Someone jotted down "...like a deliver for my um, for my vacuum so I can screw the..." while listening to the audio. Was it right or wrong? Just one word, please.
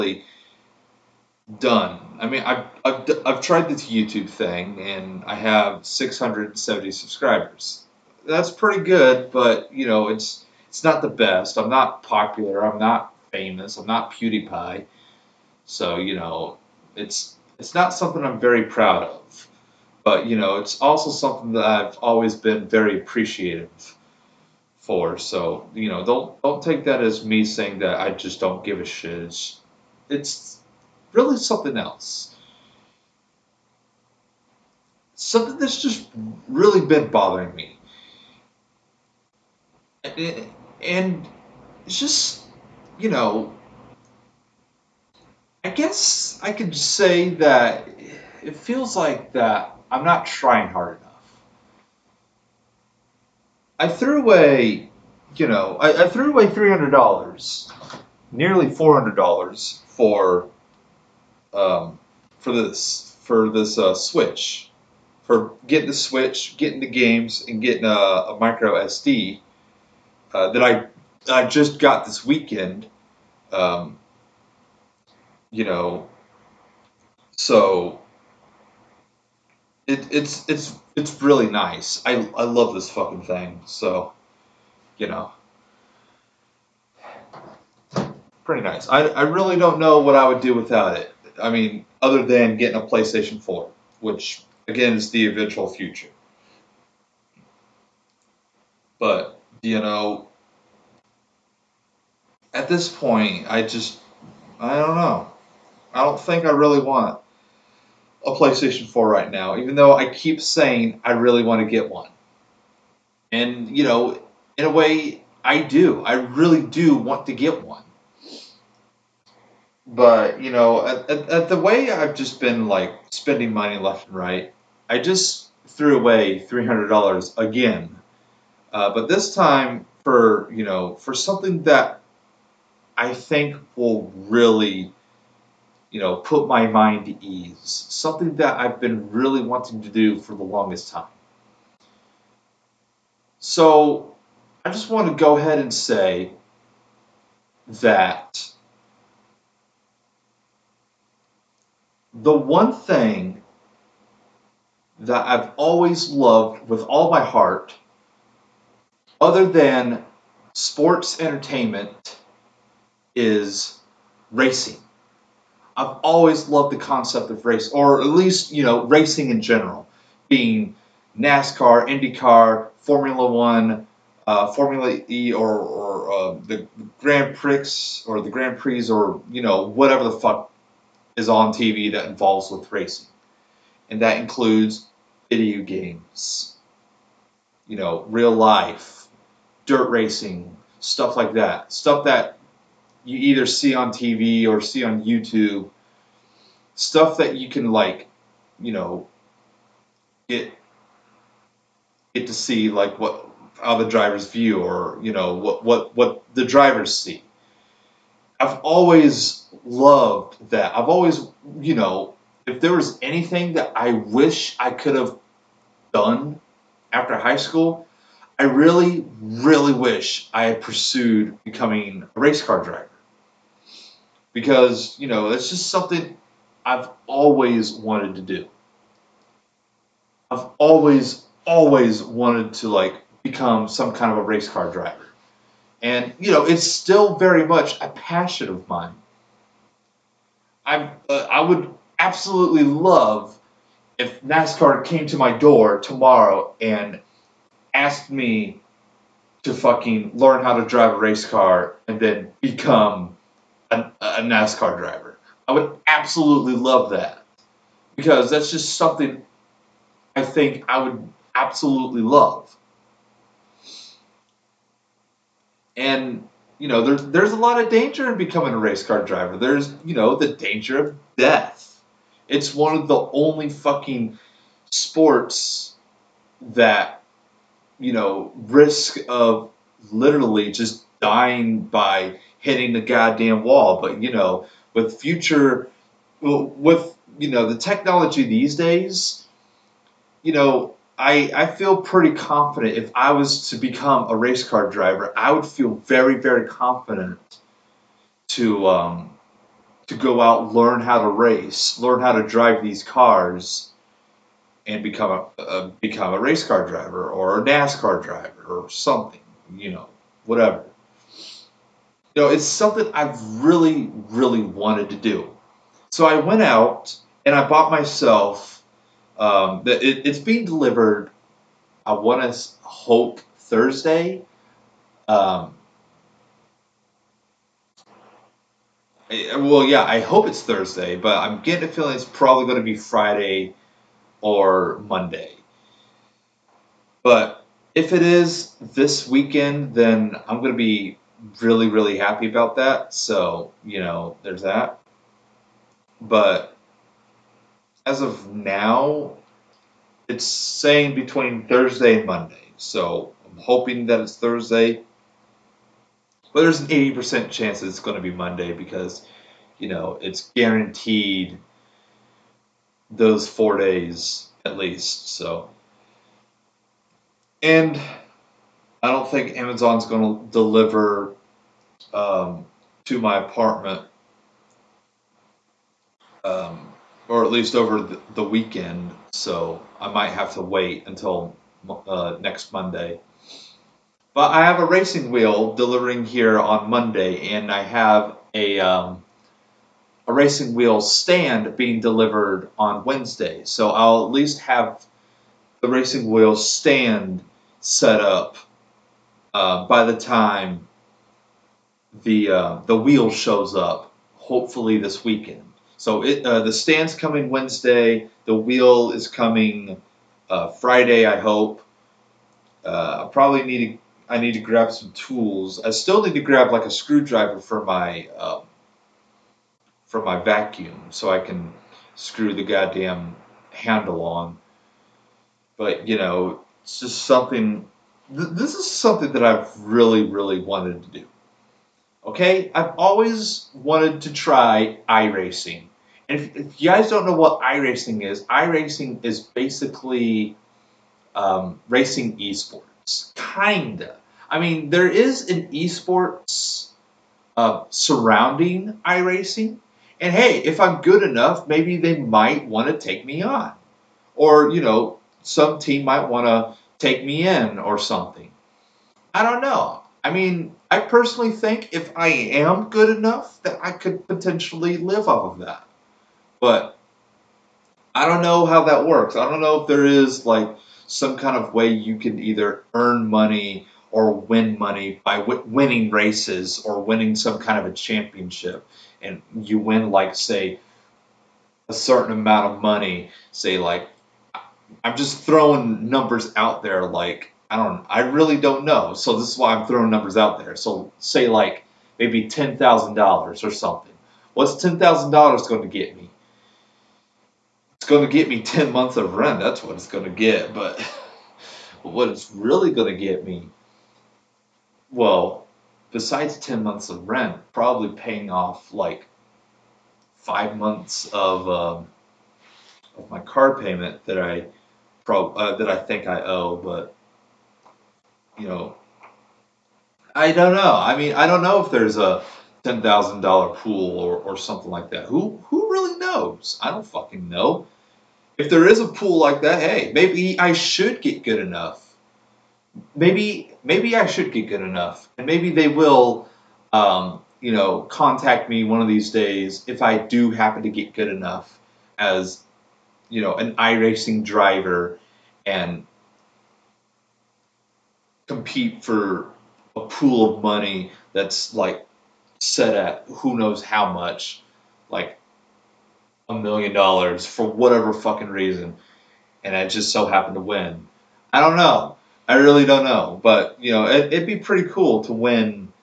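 wrong.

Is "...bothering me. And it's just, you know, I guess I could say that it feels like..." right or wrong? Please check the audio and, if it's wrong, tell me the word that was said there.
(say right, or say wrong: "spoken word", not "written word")
right.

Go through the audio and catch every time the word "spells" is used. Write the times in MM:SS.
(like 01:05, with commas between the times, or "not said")
not said.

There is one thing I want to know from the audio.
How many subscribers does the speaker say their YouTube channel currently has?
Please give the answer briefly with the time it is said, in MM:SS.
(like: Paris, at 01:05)
670, at 00:05.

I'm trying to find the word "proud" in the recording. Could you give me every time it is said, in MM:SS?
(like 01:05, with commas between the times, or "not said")
00:18.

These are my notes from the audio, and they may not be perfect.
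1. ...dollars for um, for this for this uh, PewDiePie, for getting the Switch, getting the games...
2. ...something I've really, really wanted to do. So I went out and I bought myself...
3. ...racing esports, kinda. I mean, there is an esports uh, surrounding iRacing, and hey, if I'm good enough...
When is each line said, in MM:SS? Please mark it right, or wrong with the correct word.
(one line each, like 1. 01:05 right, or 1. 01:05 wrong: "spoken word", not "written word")
1. 00:59 wrong: "Switch", not "PewDiePie"
2. 05:12 right
3. 07:21 right.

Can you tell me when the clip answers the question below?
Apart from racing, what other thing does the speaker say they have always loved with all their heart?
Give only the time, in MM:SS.
02:40.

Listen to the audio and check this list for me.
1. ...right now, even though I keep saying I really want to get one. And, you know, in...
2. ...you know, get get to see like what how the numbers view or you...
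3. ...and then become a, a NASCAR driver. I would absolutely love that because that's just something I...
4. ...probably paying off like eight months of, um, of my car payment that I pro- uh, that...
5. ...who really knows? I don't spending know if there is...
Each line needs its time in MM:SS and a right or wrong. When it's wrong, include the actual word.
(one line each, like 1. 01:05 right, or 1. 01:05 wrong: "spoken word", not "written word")
1. 01:49 right
2. 03:18 wrong: "drivers", not "numbers"
3. 04:11 right
4. 08:27 wrong: "five", not "eight"
5. 08:45 wrong: "fucking", not "spending".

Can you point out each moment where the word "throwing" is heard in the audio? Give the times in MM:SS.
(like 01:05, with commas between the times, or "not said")
08:05, 08:09.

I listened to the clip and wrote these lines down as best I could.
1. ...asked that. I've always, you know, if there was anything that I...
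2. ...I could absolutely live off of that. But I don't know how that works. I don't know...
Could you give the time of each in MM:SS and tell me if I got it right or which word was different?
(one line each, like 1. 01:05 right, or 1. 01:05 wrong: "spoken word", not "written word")
1. 03:29 wrong: "loved", not "asked"
2. 07:43 wrong: "potentially", not "absolutely".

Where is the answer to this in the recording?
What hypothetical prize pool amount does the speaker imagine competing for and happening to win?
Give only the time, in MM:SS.
09:16.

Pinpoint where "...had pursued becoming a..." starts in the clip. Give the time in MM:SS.
03:40.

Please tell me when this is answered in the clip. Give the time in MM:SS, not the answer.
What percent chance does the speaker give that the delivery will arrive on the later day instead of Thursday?
05:56.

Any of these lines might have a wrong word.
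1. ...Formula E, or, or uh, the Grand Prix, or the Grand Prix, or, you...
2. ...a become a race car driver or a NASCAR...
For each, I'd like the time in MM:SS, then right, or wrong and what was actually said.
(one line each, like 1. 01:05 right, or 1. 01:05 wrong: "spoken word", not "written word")
1. 02:54 right
2. 05:05 right.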